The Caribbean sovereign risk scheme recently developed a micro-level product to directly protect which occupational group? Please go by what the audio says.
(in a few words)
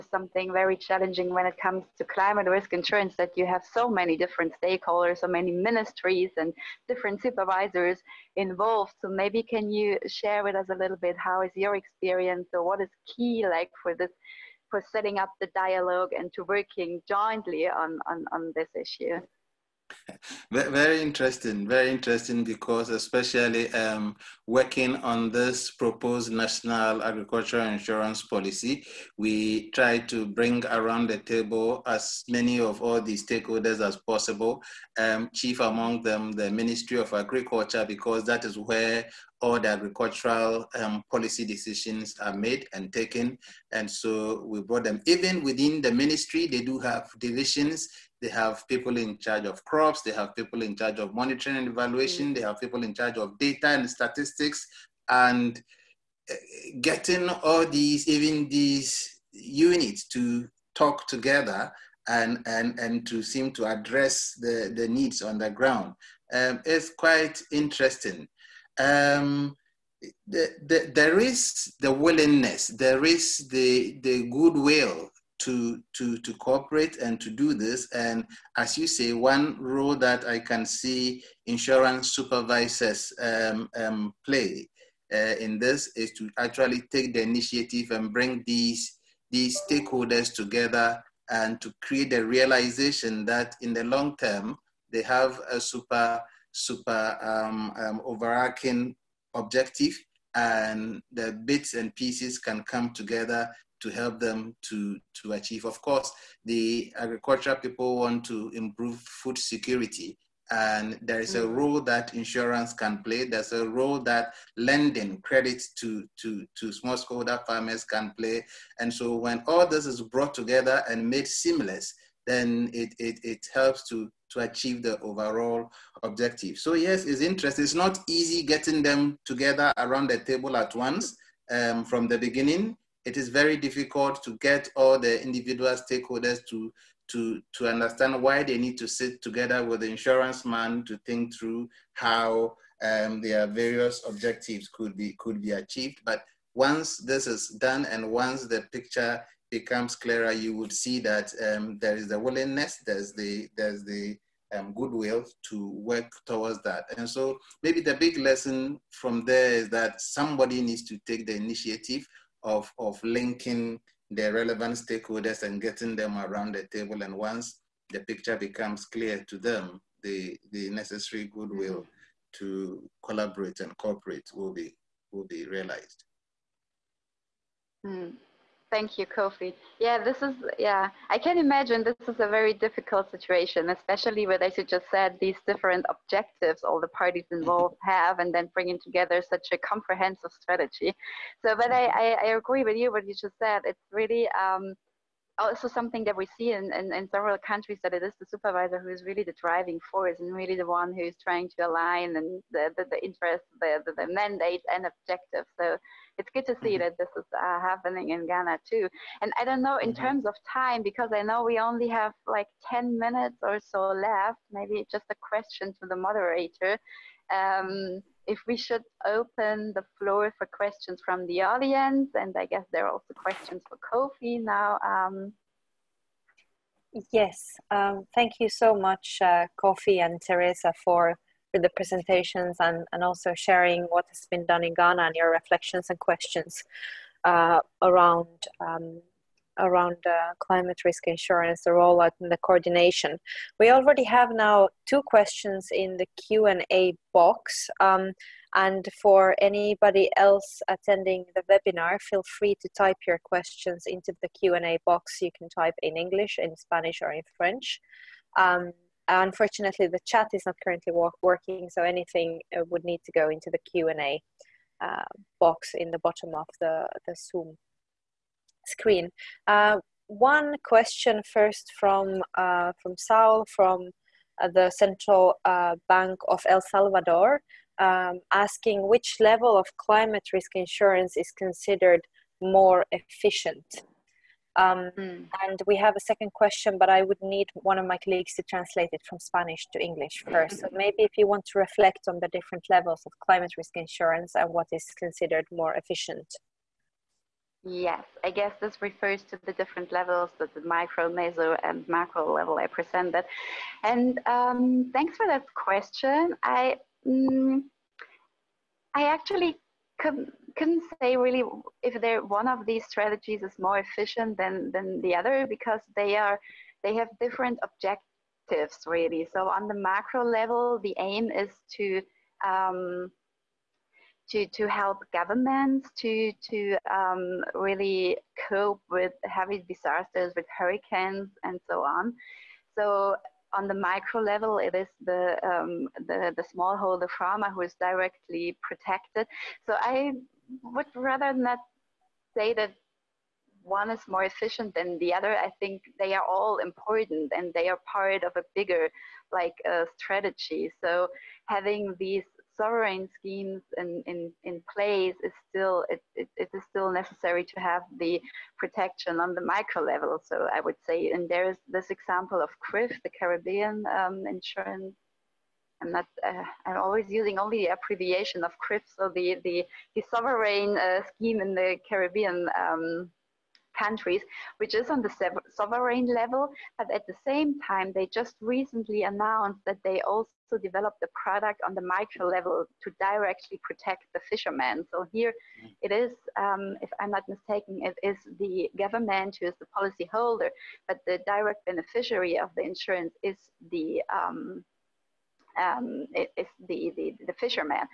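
fishermen.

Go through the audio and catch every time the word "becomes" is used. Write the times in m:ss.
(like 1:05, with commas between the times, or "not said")
2:29, 2:48.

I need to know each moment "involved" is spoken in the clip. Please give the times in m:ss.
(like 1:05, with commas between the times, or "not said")
0:08, 3:07.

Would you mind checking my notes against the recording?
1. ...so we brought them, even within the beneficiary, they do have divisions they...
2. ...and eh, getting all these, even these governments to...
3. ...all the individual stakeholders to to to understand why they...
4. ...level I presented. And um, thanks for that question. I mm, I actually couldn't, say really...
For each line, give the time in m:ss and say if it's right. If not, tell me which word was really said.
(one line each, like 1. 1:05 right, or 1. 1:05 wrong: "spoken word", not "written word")
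1. 0:43 wrong: "ministry", not "beneficiary"
2. 0:55 wrong: "units", not "governments"
3. 2:14 right
4. 5:02 right.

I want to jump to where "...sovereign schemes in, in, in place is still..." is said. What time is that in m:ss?
5:52.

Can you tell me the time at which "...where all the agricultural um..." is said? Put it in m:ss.
0:38.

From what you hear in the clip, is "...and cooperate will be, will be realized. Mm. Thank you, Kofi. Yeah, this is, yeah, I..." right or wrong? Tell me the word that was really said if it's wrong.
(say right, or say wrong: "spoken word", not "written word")
right.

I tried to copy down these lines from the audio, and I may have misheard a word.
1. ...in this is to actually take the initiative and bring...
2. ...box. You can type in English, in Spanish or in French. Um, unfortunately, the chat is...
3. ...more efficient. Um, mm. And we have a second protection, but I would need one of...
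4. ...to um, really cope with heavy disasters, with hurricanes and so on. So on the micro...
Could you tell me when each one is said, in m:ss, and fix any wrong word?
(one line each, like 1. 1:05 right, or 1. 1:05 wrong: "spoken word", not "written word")
1. 1:25 right
2. 4:14 right
3. 4:42 wrong: "question", not "protection"
4. 5:26 right.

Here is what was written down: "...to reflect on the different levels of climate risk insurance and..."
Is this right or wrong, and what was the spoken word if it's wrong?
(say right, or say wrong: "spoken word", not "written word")
right.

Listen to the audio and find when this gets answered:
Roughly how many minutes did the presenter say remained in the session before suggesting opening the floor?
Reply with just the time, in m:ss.
3:32.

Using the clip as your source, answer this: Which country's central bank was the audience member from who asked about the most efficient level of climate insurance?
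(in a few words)
El Salvador.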